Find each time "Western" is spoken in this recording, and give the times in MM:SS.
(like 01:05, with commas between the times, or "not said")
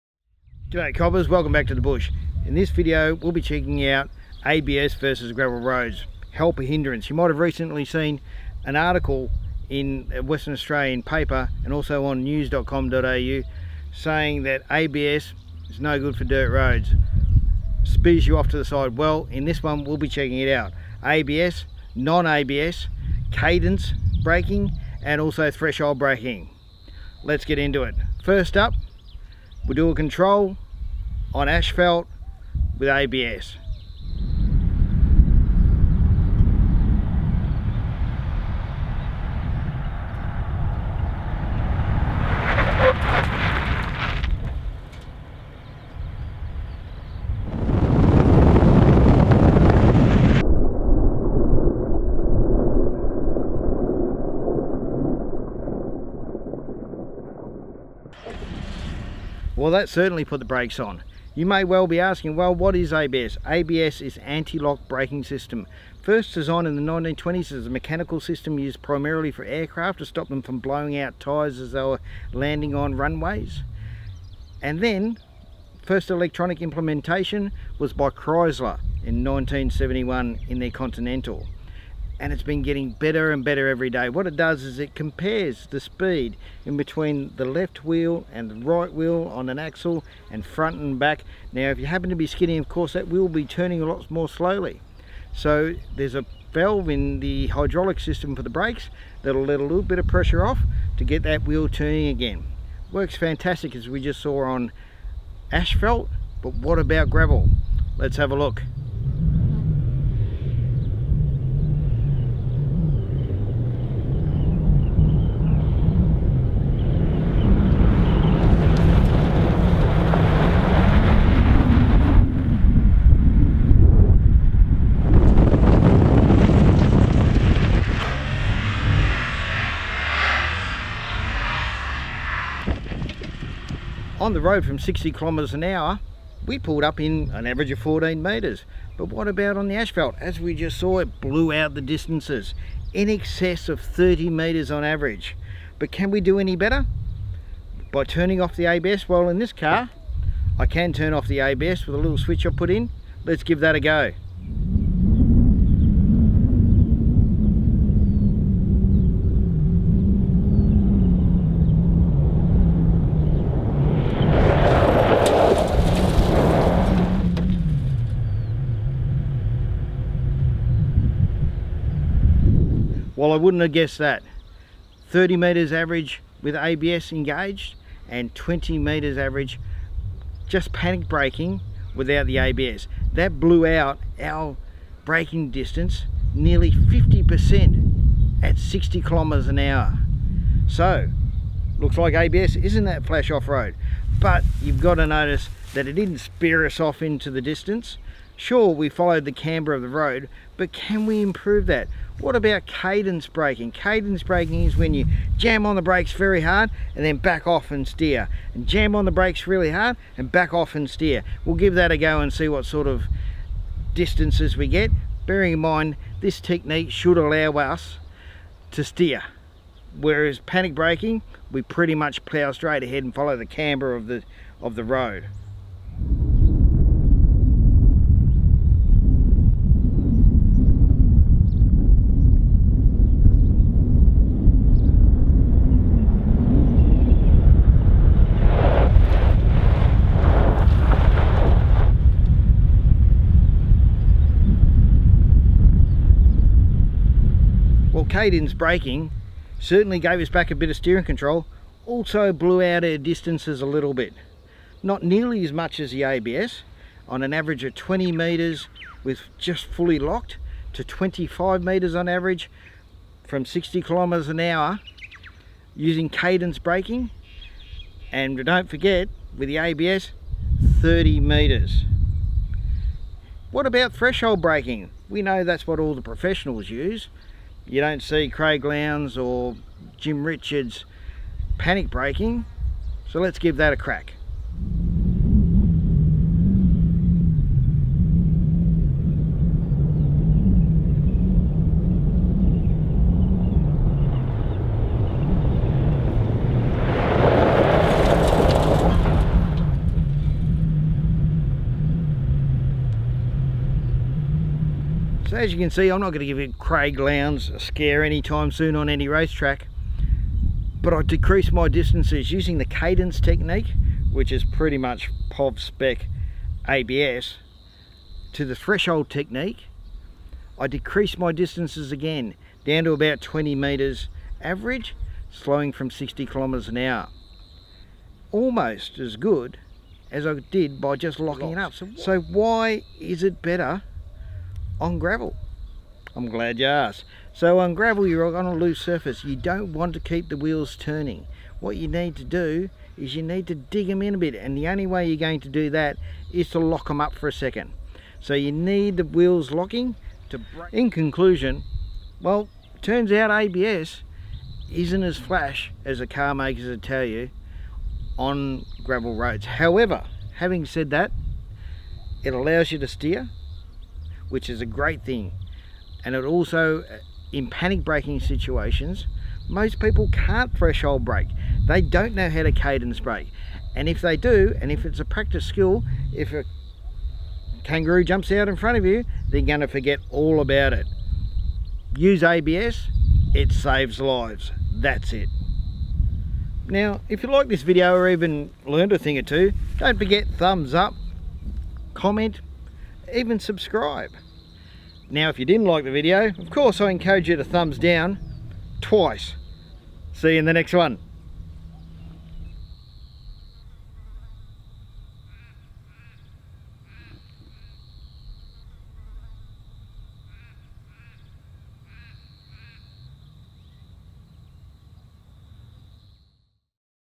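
00:10.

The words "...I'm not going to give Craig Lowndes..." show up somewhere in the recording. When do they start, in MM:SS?
05:05.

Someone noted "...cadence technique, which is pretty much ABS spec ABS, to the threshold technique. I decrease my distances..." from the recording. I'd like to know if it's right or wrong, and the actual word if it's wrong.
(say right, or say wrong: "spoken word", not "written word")
wrong: "POV", not "ABS".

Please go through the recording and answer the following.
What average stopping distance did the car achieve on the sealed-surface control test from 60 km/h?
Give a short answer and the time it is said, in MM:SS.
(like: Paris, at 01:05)
14 metres, at 02:17.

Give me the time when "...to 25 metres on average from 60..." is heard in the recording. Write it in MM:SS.
04:20.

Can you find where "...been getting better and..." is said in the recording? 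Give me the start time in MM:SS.
01:22.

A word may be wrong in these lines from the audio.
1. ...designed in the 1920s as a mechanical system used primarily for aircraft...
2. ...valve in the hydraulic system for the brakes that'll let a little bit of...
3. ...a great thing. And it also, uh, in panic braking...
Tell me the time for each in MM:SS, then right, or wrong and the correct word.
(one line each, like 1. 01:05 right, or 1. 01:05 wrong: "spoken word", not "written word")
1. 01:06 right
2. 01:36 right
3. 06:04 right.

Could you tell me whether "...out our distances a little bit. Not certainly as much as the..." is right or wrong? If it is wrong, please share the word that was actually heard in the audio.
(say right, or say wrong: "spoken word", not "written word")
wrong: "nearly", not "certainly".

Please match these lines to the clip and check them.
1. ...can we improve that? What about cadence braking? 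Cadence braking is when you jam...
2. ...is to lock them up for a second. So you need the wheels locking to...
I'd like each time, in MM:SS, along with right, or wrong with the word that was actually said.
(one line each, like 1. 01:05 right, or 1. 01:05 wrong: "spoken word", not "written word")
1. 03:20 right
2. 05:46 right.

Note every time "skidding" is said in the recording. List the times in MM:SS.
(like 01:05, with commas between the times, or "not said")
01:32.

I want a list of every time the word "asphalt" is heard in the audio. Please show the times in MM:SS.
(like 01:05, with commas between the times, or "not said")
00:31, 01:45, 02:19.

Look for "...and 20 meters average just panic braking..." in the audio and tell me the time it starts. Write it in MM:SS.
02:58.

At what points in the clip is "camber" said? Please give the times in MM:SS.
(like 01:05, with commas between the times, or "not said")
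03:19, 03:43.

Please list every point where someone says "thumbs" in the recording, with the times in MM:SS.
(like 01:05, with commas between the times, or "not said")
06:30, 06:37.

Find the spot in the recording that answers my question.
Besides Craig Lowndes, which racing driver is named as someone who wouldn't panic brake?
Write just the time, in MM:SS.
04:39.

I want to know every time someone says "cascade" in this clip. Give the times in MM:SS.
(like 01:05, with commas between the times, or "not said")
not said.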